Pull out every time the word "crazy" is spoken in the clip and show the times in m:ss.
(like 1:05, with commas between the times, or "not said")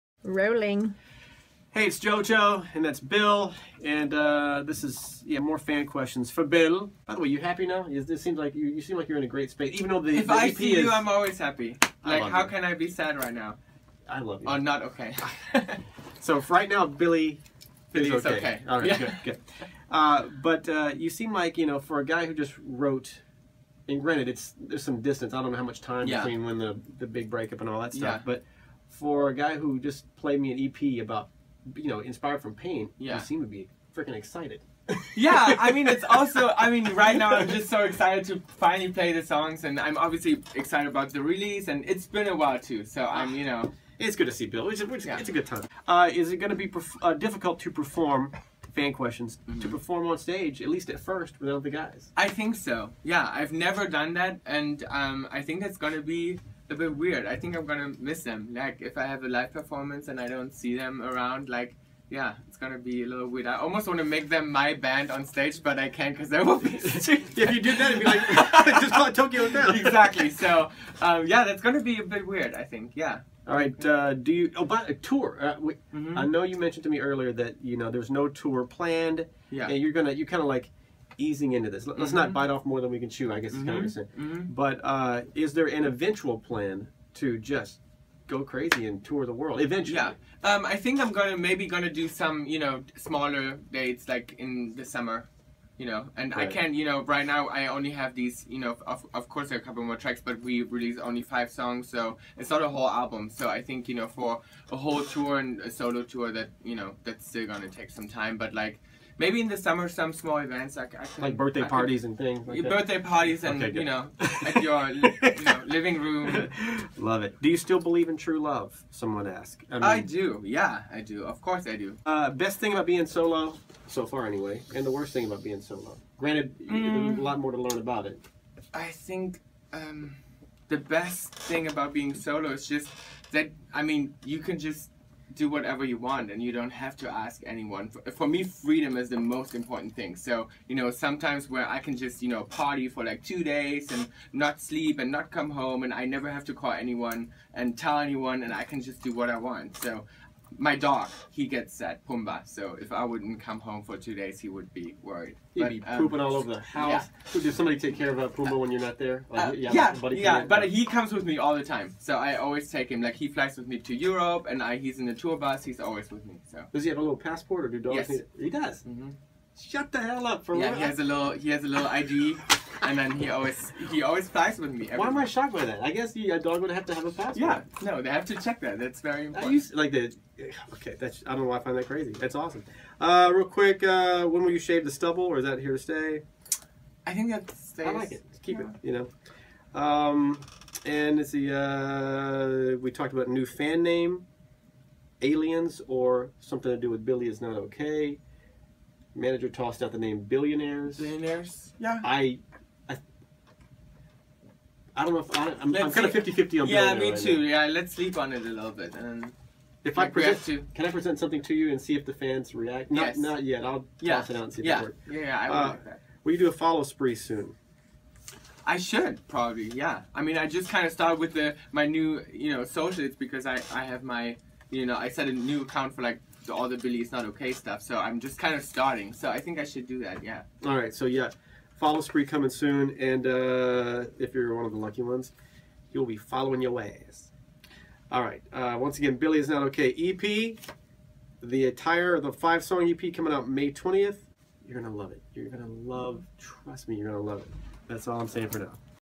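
1:28, 3:01.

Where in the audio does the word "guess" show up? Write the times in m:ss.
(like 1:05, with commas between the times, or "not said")
1:23, 2:55.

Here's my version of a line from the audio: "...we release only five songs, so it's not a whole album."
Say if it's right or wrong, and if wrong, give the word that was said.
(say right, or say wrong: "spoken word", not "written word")
right.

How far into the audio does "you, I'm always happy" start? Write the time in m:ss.
0:10.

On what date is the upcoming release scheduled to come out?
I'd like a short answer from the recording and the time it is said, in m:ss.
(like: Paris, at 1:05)
May 20, at 4:03.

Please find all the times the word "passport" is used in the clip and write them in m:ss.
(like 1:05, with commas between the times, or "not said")
2:47, 2:57.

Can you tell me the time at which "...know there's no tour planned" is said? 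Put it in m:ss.
1:17.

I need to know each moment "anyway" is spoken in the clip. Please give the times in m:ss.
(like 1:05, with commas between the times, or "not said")
2:04.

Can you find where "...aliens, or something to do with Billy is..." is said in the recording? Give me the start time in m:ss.
3:15.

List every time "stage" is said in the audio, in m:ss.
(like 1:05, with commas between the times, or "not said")
0:50, 1:05.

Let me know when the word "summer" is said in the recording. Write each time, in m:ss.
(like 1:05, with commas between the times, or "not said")
1:34, 1:49.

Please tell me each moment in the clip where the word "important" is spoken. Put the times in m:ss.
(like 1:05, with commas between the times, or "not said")
2:19, 2:59.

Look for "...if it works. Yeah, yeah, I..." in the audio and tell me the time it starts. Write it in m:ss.
3:34.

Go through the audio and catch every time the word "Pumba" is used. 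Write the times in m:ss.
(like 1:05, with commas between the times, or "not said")
2:32, 2:38.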